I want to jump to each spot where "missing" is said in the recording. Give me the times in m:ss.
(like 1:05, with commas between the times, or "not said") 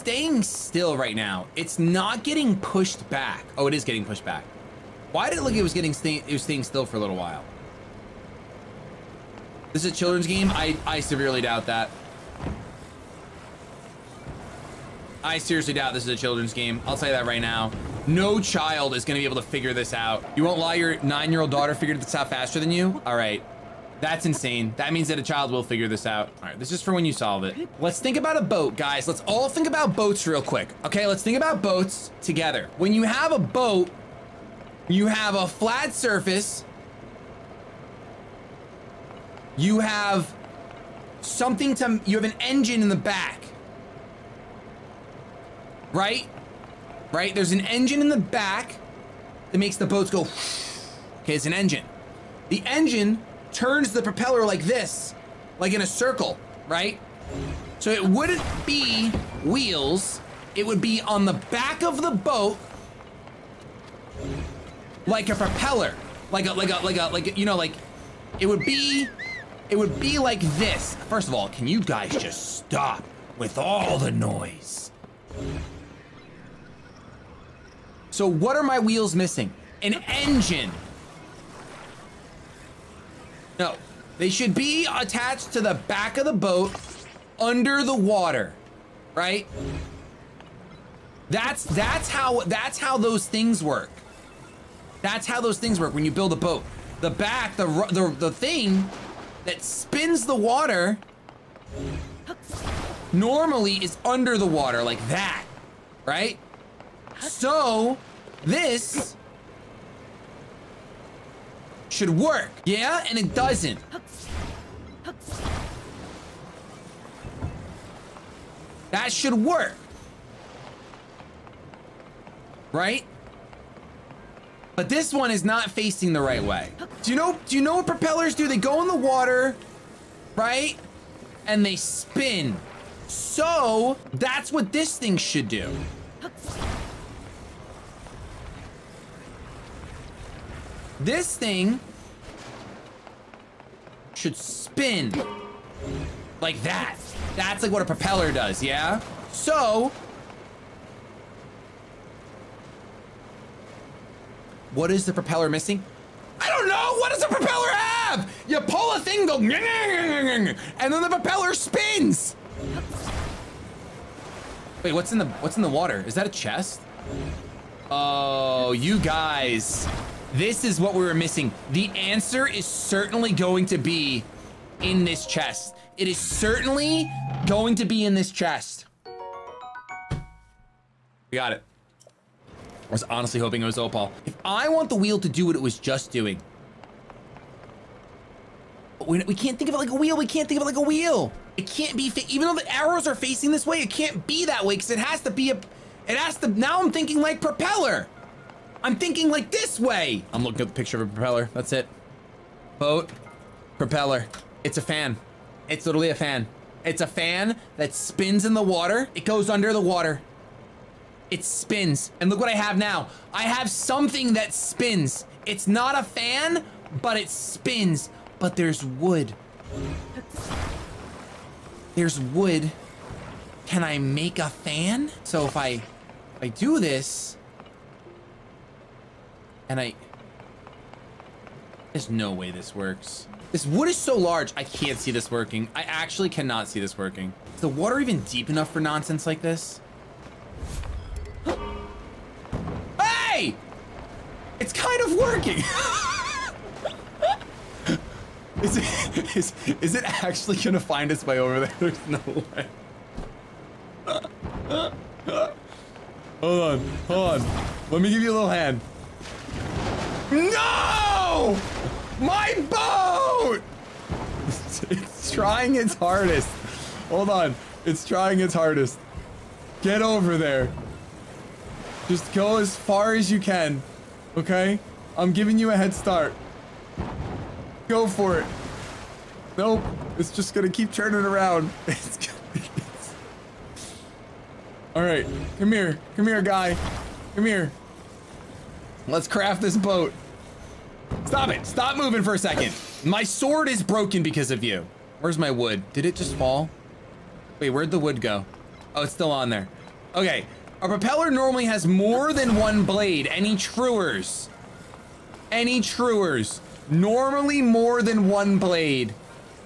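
1:19, 2:35, 2:51.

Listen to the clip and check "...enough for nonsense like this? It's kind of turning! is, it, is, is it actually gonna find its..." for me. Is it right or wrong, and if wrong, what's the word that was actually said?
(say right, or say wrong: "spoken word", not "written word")
wrong: "working", not "turning".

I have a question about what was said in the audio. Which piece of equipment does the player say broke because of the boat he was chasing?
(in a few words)
sword.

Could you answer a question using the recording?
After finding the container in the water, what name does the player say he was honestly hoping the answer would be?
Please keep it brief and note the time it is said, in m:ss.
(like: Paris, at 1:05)
Opal, at 3:03.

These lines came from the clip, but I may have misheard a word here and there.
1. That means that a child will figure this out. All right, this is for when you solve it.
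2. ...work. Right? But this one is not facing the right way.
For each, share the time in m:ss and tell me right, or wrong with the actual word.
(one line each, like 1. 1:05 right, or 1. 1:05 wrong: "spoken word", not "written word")
1. 0:24 right
2. 1:59 right.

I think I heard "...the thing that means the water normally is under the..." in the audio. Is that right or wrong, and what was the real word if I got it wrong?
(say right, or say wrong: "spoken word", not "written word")
wrong: "spins", not "means".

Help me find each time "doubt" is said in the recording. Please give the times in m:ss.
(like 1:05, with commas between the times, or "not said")
0:11, 0:15.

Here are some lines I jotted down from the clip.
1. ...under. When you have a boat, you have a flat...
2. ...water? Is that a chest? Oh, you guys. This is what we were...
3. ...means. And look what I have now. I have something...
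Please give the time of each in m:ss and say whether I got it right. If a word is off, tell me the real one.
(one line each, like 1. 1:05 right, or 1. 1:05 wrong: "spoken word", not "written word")
1. 0:32 wrong: "together", not "under"
2. 2:45 right
3. 3:31 wrong: "spins", not "means".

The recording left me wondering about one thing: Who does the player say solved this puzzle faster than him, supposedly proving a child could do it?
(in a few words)
nine-year-old daughter.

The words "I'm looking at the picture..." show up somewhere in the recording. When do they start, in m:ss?
3:20.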